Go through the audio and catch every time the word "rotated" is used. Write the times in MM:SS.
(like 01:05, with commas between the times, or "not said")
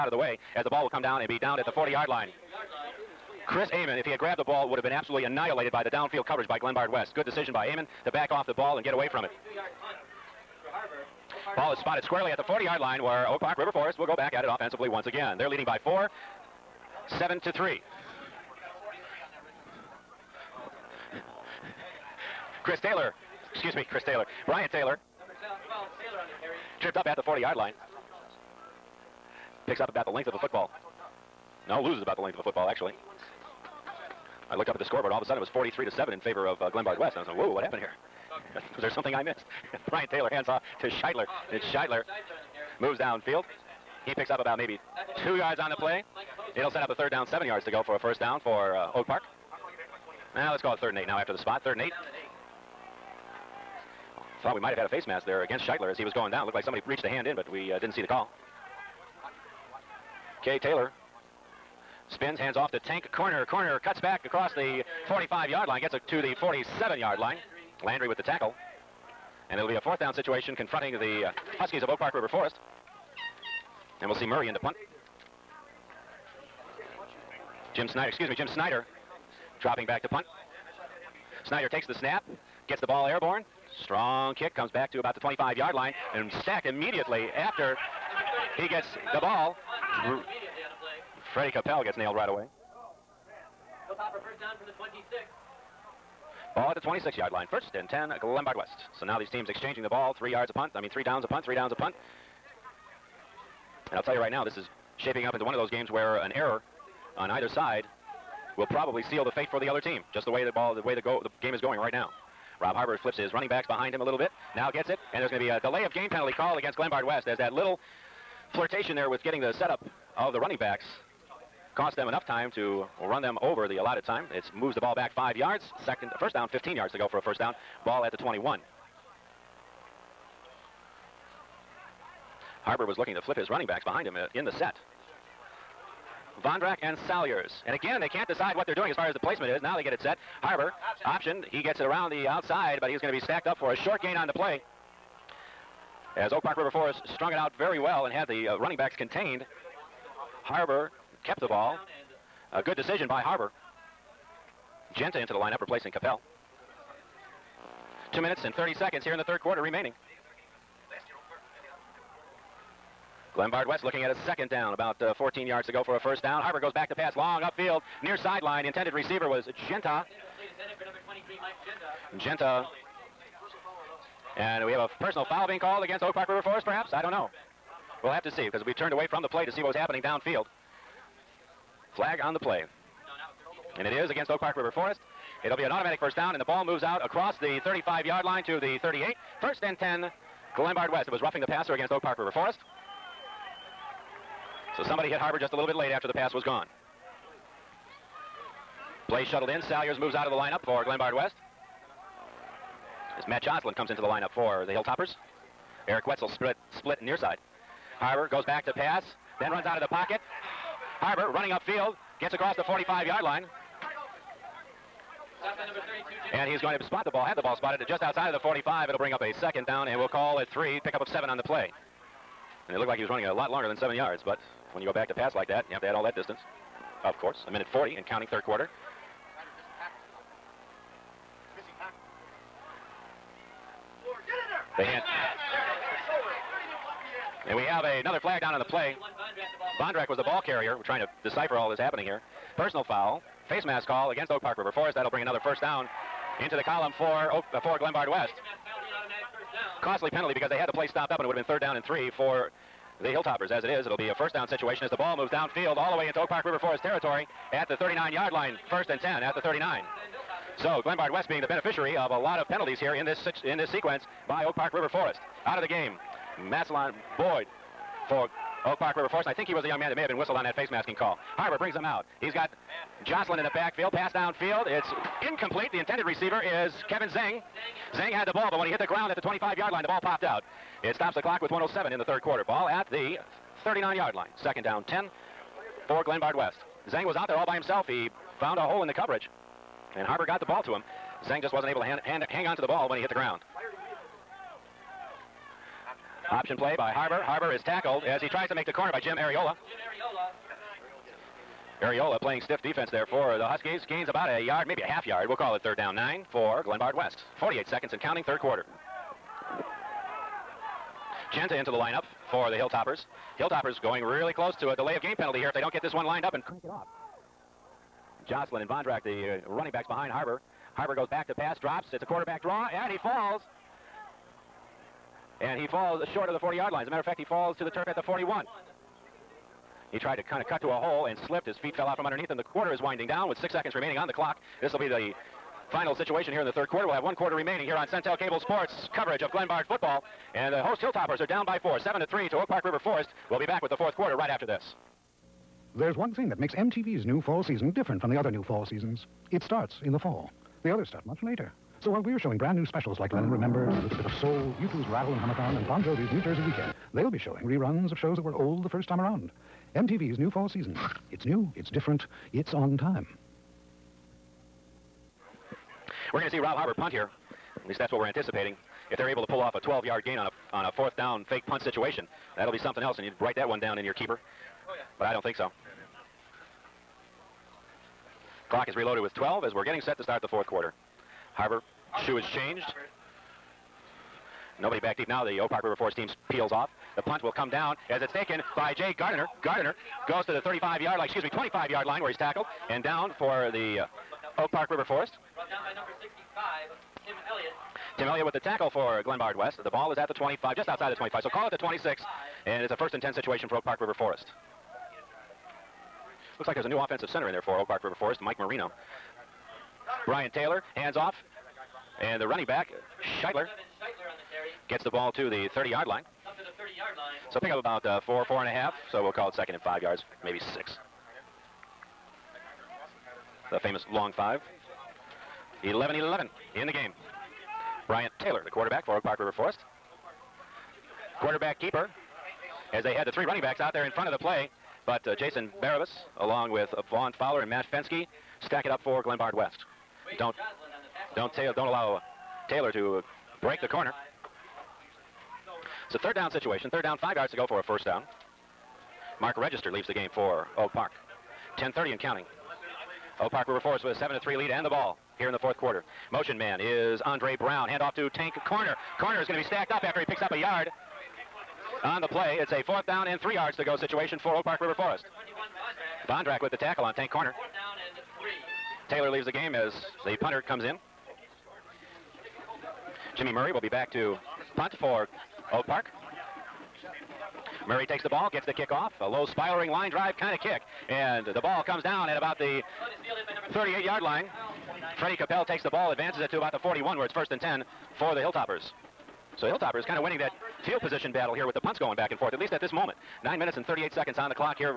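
not said.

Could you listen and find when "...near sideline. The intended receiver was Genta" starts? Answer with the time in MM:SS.
02:48.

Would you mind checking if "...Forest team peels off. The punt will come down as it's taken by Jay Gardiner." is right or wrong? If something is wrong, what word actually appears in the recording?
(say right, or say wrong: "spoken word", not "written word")
right.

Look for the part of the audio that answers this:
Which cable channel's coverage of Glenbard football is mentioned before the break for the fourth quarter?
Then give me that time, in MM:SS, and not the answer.
05:37.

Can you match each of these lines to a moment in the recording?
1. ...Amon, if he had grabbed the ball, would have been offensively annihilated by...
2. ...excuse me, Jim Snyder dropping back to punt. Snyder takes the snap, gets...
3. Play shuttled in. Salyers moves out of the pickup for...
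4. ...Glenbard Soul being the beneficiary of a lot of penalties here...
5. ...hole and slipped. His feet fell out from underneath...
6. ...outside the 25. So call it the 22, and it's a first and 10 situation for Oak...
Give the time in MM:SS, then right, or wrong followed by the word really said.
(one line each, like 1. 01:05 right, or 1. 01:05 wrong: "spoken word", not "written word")
1. 00:03 wrong: "absolutely", not "offensively"
2. 01:18 right
3. 03:19 wrong: "lineup", not "pickup"
4. 04:20 wrong: "West", not "Soul"
5. 05:30 right
6. 06:40 wrong: "26", not "22".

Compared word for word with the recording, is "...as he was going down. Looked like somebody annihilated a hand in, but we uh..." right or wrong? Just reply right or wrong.
wrong.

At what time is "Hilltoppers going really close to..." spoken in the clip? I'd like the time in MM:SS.
05:13.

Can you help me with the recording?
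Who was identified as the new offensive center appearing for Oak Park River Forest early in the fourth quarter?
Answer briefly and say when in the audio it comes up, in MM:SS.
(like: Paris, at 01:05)
Mike Marino, at 06:48.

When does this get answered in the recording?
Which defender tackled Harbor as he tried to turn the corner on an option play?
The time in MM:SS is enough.
04:58.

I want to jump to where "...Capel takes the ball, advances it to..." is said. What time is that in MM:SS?
08:05.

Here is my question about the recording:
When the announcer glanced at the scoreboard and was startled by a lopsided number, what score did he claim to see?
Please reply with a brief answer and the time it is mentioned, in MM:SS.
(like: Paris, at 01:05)
43 to 7, at 00:35.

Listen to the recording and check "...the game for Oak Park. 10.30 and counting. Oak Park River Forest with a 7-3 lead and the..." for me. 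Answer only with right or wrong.
right.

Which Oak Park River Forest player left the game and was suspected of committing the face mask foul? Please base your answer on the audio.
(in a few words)
Massillon Boyd.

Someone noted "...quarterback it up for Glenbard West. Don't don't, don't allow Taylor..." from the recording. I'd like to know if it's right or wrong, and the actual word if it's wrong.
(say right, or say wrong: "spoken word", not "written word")
wrong: "stack", not "quarterback".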